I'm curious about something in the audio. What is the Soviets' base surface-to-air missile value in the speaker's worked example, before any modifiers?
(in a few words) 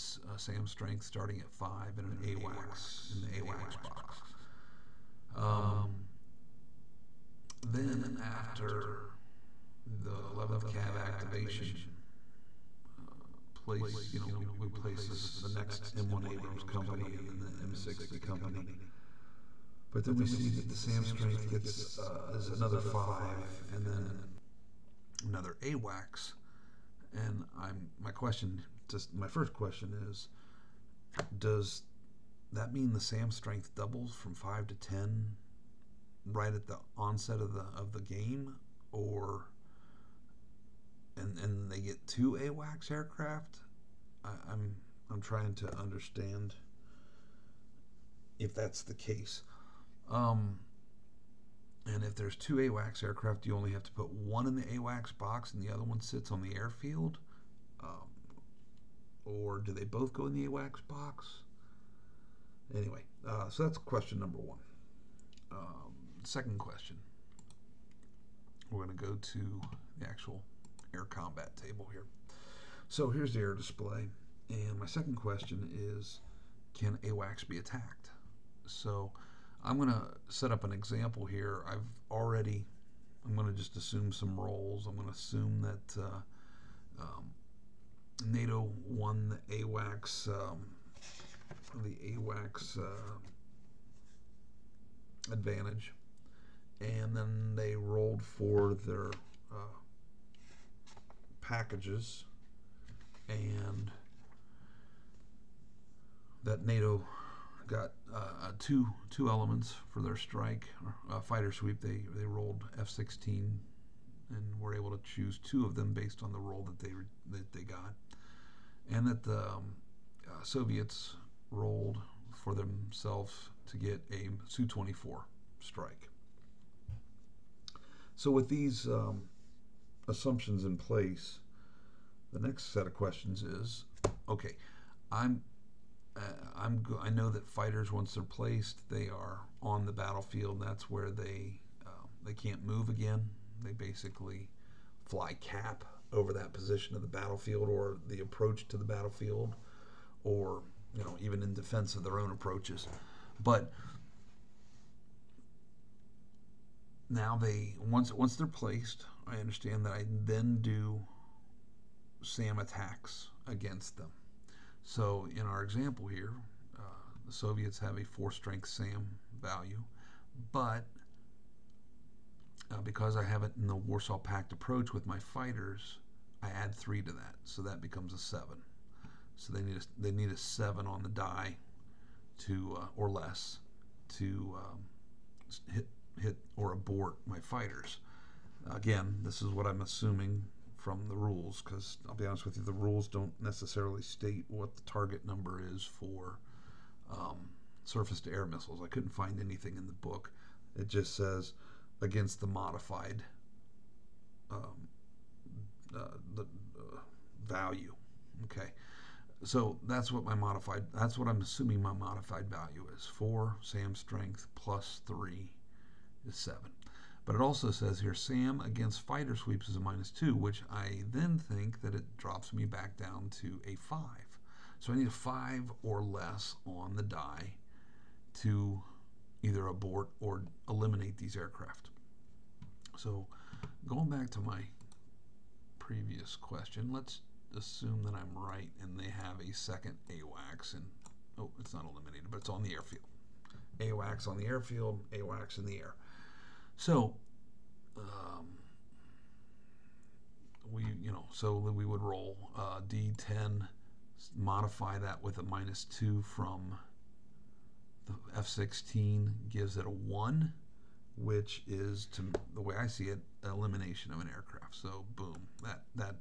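4.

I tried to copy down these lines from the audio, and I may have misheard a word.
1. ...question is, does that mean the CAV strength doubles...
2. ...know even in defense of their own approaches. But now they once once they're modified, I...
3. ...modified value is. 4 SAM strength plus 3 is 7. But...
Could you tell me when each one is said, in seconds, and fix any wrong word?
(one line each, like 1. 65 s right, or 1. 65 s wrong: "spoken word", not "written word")
1. 29 s wrong: "SAM", not "CAV"
2. 151 s wrong: "placed", not "modified"
3. 211 s right.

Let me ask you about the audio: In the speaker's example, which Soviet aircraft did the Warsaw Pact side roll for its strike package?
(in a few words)
Su-24.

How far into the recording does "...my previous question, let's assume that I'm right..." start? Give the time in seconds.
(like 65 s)
234 s.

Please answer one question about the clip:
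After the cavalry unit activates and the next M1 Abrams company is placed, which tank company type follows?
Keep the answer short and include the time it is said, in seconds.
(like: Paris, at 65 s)
M60 company, at 17 s.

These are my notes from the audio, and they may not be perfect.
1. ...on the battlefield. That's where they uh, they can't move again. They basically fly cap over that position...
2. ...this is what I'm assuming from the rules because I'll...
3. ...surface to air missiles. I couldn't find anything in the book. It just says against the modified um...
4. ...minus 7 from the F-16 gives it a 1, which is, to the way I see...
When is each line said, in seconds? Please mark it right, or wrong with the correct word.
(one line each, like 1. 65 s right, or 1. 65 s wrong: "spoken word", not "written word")
1. 139 s right
2. 189 s right
3. 197 s right
4. 255 s wrong: "2", not "7".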